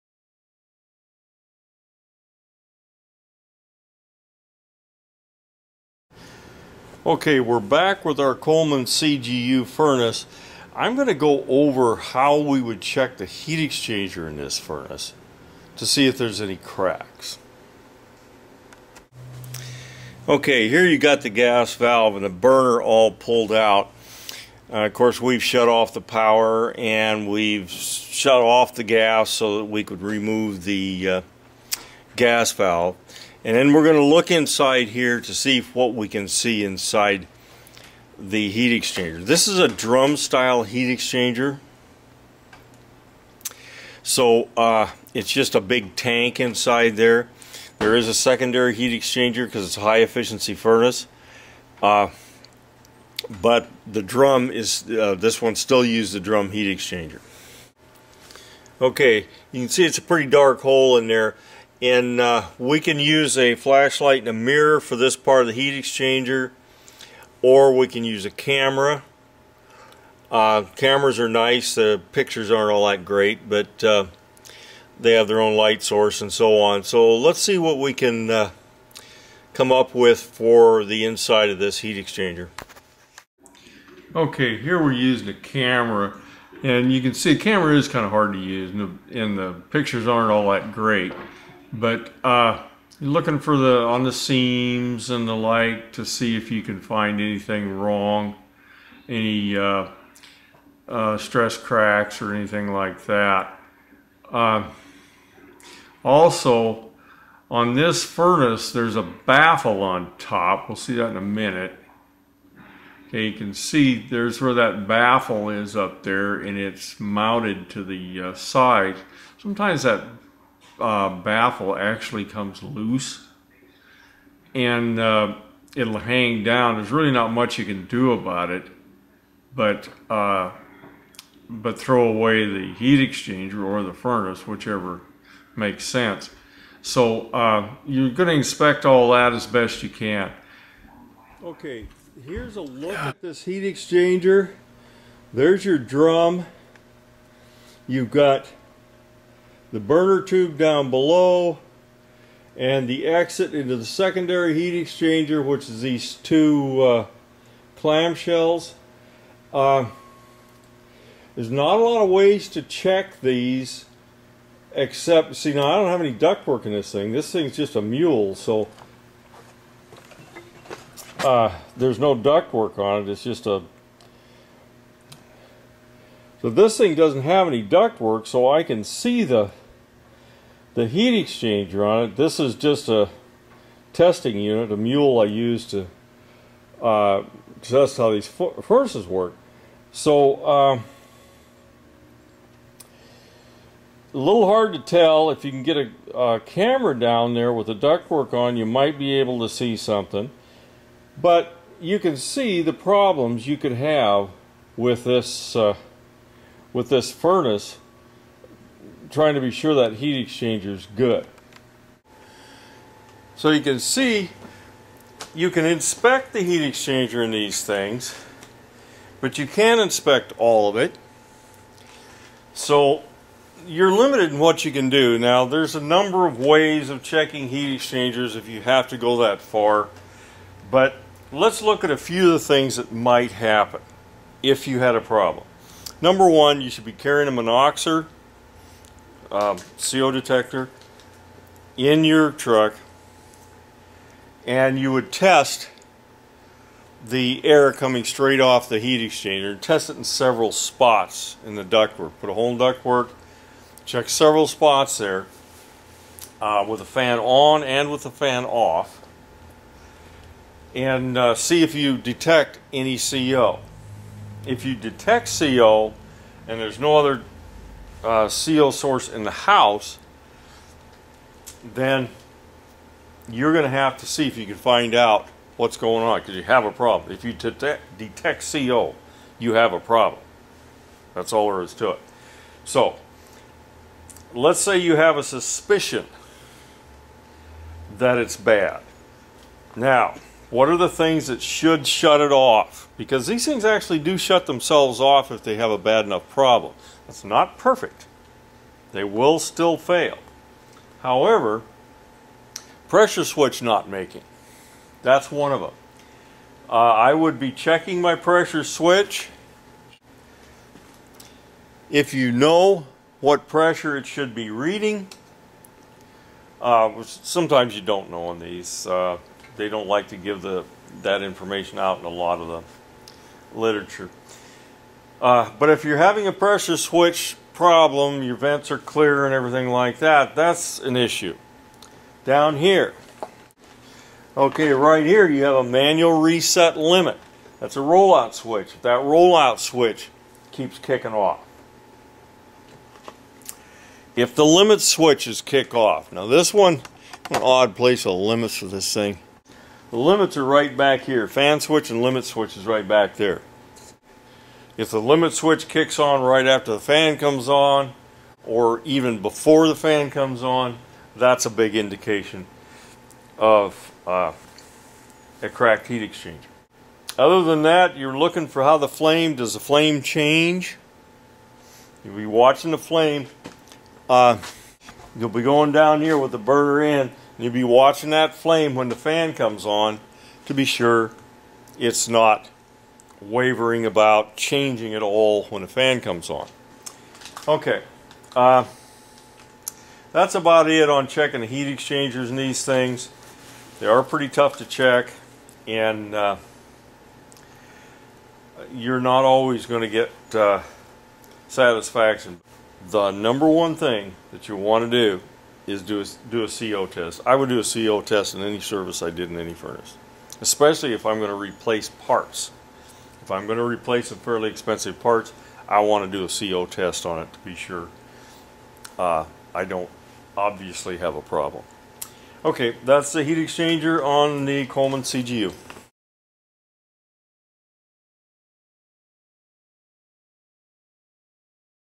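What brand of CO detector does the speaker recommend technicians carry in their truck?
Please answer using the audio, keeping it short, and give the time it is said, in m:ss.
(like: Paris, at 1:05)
Monoxor, at 3:57.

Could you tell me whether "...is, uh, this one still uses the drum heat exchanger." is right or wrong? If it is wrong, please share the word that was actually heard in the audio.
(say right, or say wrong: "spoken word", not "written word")
right.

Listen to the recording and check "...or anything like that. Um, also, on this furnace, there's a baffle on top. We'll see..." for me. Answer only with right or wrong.
right.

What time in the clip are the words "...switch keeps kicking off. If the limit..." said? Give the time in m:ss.
5:39.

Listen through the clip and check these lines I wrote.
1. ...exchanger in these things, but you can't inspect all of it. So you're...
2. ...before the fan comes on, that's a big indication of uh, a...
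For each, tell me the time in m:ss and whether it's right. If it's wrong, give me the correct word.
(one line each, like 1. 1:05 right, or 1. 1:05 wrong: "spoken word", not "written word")
1. 3:36 right
2. 5:59 right.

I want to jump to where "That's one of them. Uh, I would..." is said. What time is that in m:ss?
5:05.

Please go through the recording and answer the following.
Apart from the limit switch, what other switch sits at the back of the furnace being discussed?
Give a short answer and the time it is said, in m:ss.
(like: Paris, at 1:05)
Fan switch, at 5:51.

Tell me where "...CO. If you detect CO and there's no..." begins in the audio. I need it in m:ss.
4:22.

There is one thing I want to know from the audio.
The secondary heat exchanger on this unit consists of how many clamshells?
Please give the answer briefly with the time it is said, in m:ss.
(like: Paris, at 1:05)
2, at 2:36.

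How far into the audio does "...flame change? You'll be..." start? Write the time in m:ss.
6:09.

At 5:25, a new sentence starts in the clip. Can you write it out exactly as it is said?
Uh, but if you're having a pressure switch problem, your vents are clear and everything like that, that's an issue.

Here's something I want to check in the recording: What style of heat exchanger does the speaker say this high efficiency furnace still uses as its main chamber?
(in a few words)
Drum style.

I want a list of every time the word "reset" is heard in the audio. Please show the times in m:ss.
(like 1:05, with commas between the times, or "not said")
5:36.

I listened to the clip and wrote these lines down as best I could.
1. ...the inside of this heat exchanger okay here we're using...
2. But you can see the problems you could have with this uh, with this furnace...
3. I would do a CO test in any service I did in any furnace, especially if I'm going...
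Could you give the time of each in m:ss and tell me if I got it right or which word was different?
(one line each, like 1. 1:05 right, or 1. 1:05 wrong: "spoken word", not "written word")
1. 1:20 right
2. 3:21 right
3. 6:47 right.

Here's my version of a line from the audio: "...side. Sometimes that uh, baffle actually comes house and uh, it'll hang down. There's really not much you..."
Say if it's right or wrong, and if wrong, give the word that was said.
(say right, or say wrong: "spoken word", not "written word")
wrong: "loose", not "house".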